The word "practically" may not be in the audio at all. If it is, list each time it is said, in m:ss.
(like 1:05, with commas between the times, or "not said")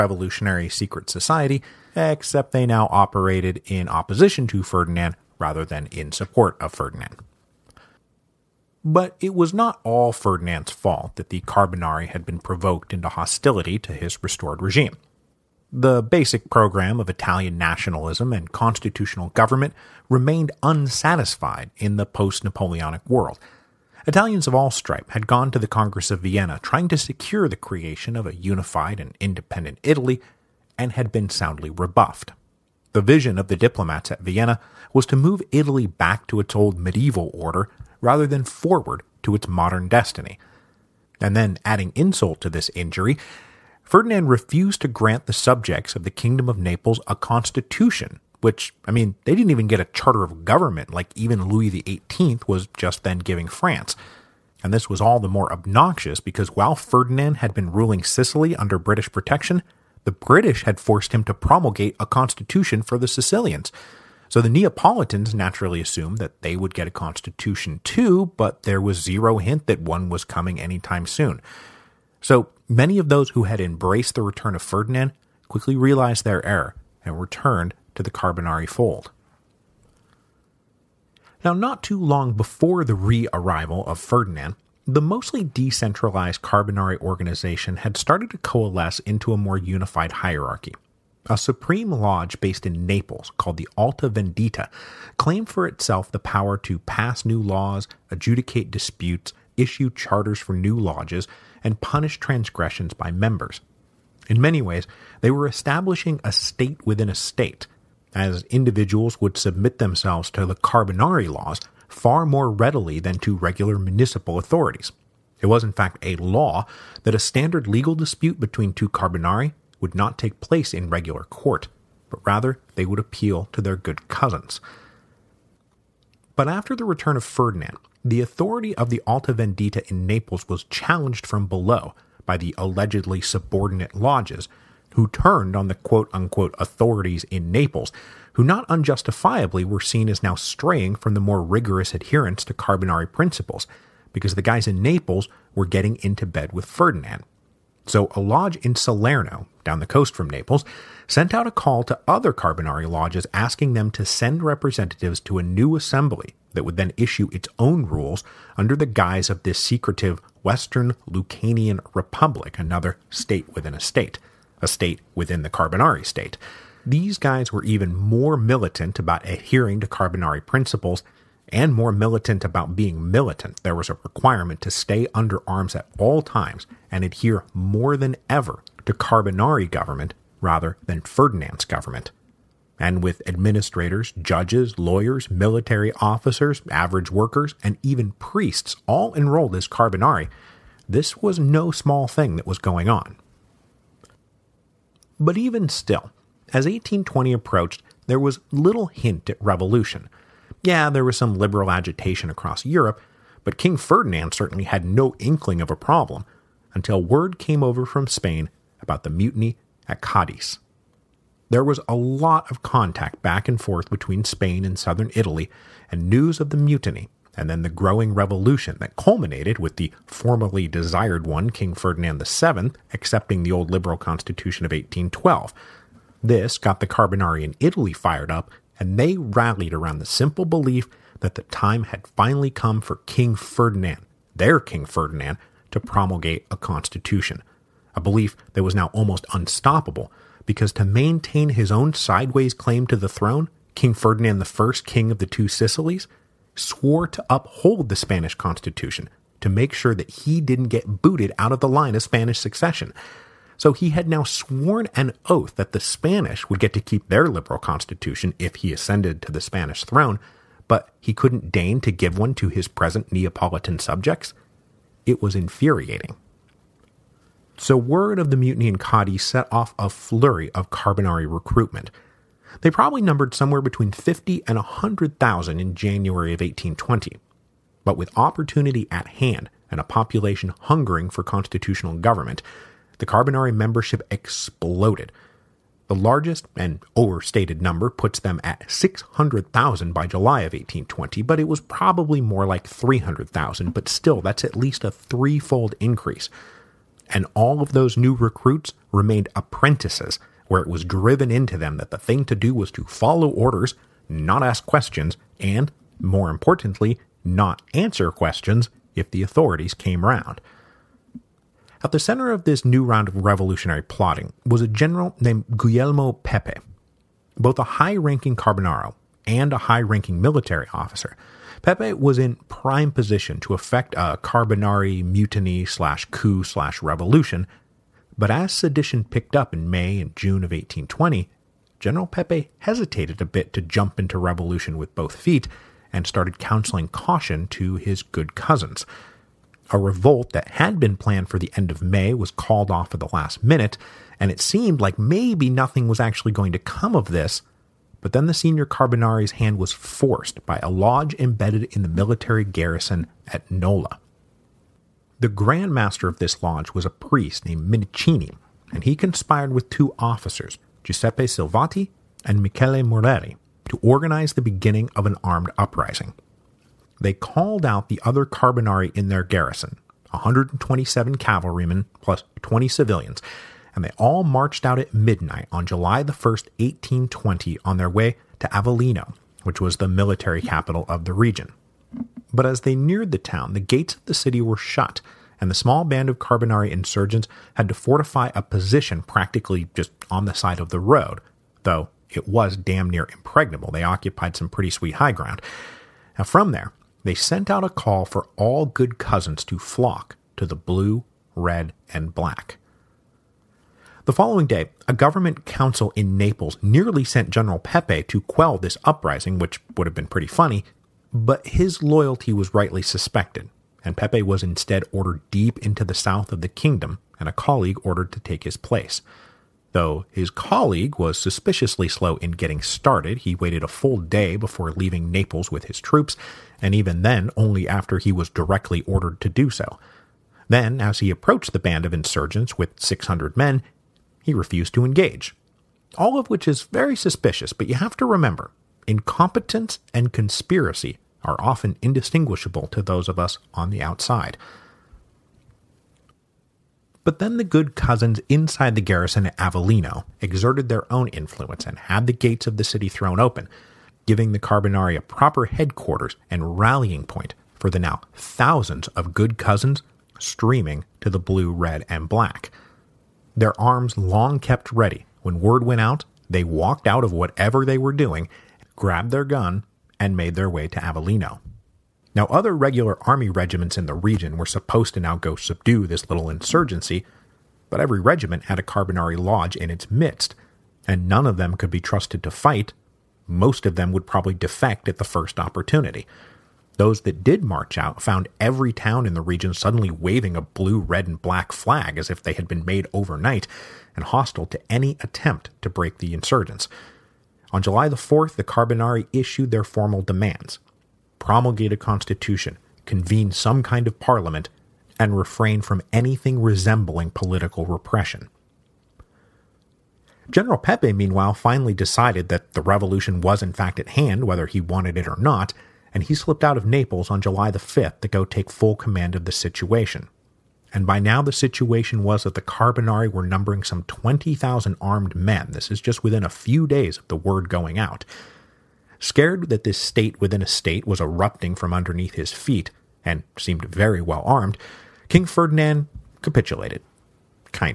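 6:29.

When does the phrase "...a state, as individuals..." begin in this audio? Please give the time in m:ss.
1:47.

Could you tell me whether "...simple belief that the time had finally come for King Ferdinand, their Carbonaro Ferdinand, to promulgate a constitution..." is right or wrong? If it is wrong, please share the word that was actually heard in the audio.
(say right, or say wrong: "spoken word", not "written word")
wrong: "King", not "Carbonaro".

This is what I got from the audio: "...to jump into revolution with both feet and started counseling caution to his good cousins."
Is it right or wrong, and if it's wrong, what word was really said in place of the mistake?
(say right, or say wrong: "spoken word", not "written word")
right.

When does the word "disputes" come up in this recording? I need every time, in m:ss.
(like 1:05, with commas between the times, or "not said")
1:38, 1:57.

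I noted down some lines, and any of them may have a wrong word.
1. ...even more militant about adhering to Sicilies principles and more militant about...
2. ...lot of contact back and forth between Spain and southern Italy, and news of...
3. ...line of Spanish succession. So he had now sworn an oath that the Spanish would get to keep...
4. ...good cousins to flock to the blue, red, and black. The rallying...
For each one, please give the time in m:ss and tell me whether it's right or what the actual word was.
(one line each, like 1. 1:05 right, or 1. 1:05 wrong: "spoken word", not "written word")
1. 2:47 wrong: "Carbonari", not "Sicilies"
2. 3:31 right
3. 4:11 right
4. 6:38 wrong: "following", not "rallying".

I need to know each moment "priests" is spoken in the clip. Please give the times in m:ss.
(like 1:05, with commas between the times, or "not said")
3:08, 5:56.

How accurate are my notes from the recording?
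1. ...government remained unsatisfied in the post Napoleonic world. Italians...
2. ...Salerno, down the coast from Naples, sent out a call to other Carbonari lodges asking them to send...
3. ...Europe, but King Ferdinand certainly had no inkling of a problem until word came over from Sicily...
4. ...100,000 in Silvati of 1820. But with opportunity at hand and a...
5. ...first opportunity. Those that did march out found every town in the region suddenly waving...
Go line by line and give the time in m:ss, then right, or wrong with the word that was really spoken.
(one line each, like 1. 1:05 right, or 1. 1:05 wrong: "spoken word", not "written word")
1. 0:19 right
2. 2:28 right
3. 3:22 wrong: "Spain", not "Sicily"
4. 4:34 wrong: "January", not "Silvati"
5. 8:05 right.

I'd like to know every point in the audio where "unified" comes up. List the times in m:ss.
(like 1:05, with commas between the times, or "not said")
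0:28, 1:29.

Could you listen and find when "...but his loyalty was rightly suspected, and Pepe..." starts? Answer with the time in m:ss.
6:51.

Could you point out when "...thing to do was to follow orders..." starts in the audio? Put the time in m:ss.
5:01.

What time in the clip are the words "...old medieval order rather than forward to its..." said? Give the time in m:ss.
0:36.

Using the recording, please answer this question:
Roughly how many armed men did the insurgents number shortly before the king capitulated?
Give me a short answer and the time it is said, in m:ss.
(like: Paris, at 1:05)
20,000, at 8:43.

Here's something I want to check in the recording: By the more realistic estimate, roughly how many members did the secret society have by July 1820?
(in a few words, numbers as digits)
300,000.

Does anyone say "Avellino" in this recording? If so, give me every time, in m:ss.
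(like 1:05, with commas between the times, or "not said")
6:18, 7:29, 7:50.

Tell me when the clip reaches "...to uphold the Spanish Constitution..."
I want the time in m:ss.
4:07.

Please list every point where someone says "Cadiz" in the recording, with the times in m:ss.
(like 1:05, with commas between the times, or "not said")
3:30, 4:28.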